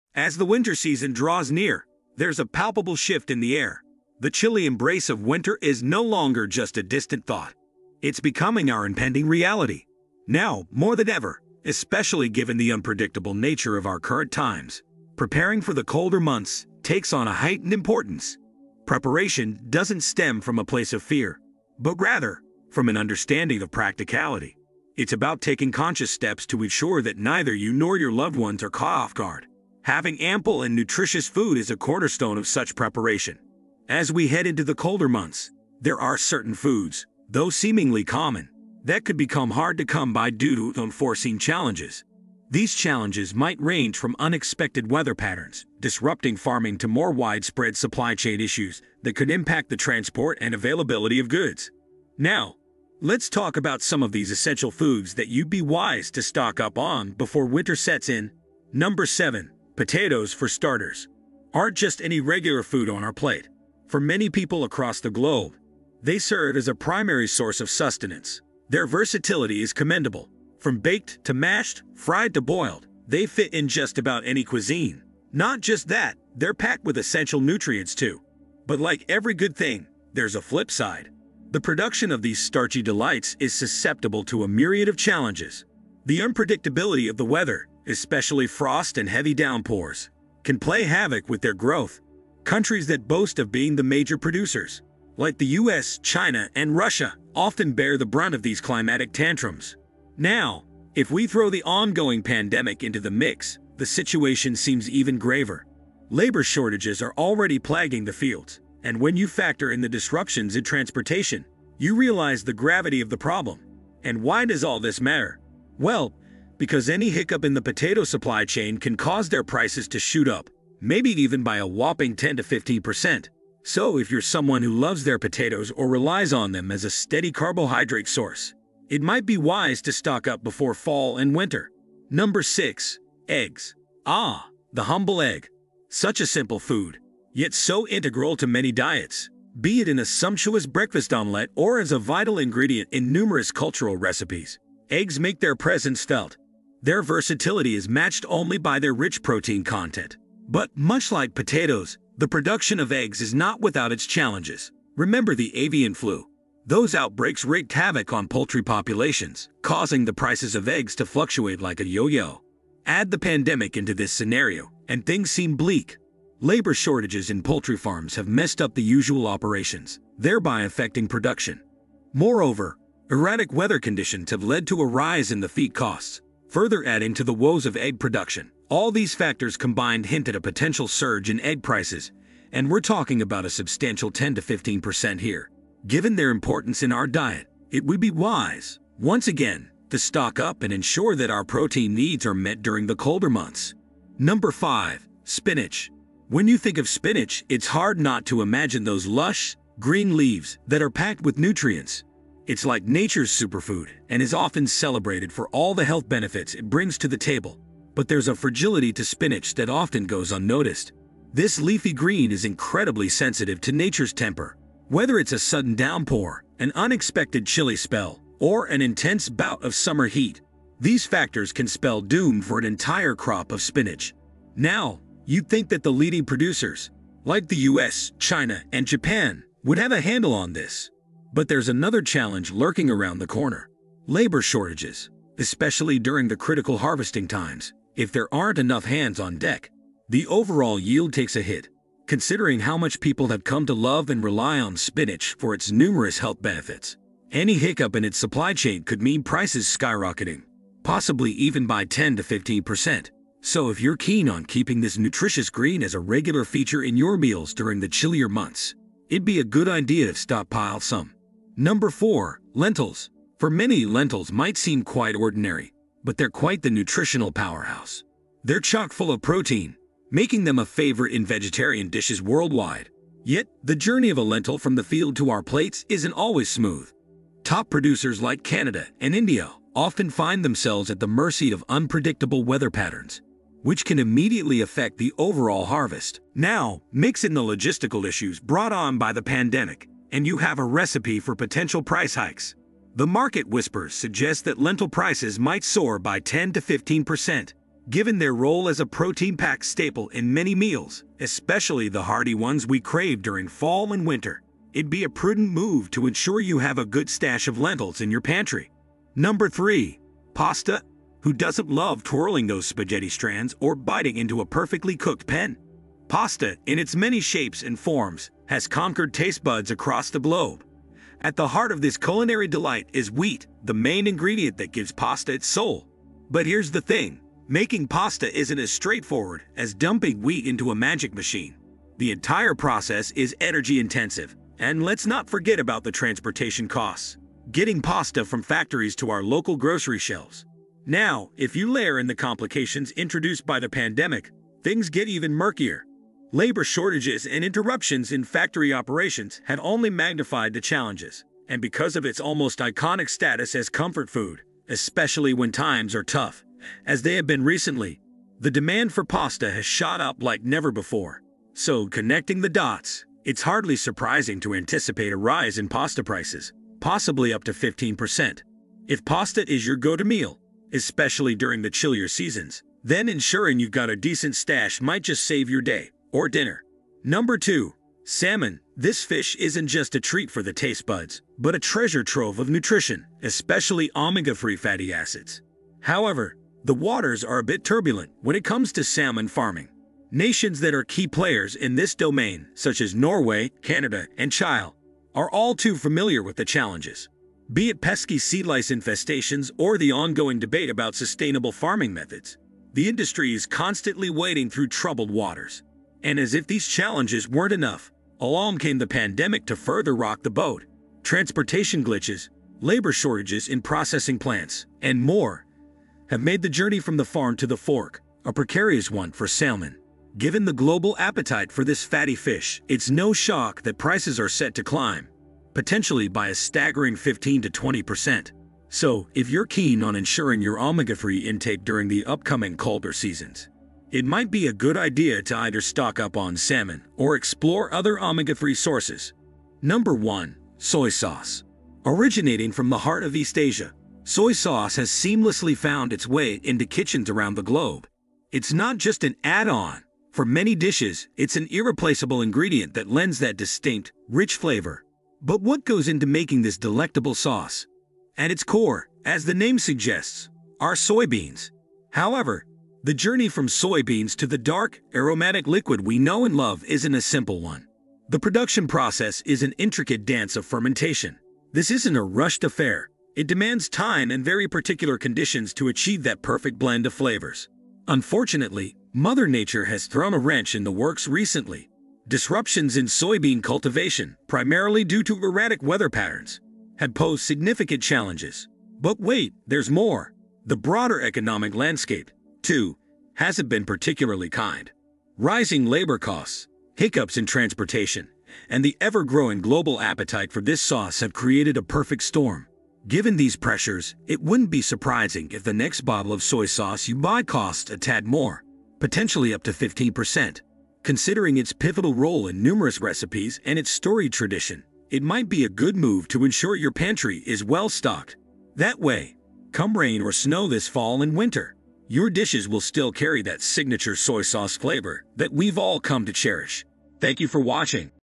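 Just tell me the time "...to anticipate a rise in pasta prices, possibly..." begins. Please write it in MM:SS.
06:04.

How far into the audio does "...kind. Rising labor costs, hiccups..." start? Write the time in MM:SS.
08:14.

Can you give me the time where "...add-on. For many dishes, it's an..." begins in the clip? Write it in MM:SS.
07:29.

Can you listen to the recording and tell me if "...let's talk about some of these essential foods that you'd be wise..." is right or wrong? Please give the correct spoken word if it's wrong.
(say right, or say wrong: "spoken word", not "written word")
right.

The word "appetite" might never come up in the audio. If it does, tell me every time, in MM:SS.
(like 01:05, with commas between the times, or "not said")
07:00, 08:19.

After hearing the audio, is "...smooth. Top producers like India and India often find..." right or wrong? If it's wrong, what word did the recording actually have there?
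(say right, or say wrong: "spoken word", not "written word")
wrong: "Canada", not "India".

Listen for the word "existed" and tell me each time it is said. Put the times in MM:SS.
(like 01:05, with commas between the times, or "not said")
not said.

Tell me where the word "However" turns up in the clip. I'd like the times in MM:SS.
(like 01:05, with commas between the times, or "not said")
06:25, 07:41.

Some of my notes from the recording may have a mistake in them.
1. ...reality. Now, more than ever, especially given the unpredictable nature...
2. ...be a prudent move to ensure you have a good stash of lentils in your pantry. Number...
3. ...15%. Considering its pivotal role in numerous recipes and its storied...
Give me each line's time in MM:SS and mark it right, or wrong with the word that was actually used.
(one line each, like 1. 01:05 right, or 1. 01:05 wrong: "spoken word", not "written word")
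1. 00:09 right
2. 05:04 right
3. 08:29 right.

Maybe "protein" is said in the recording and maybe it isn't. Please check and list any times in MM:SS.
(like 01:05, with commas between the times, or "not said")
02:29, 03:11, 04:29, 04:58.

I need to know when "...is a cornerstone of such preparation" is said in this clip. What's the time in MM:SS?
00:31.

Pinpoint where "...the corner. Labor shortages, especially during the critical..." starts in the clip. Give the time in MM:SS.
03:53.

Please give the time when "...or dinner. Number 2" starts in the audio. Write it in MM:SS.
06:16.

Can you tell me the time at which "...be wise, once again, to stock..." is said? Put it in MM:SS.
03:08.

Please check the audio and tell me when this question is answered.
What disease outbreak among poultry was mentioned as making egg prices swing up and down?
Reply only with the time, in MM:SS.
02:35.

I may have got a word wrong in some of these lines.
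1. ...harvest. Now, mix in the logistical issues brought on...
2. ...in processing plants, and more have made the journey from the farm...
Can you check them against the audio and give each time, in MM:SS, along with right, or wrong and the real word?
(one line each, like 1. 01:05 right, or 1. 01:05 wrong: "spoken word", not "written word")
1. 04:45 right
2. 06:53 right.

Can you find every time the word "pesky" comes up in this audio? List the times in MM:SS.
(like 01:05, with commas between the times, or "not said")
06:37.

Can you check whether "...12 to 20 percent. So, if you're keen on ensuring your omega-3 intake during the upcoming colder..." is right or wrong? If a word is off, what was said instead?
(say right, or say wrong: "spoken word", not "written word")
wrong: "15", not "12".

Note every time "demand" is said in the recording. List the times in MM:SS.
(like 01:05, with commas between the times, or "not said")
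05:58, 07:53.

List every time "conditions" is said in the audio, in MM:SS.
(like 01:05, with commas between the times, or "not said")
02:53, 07:54.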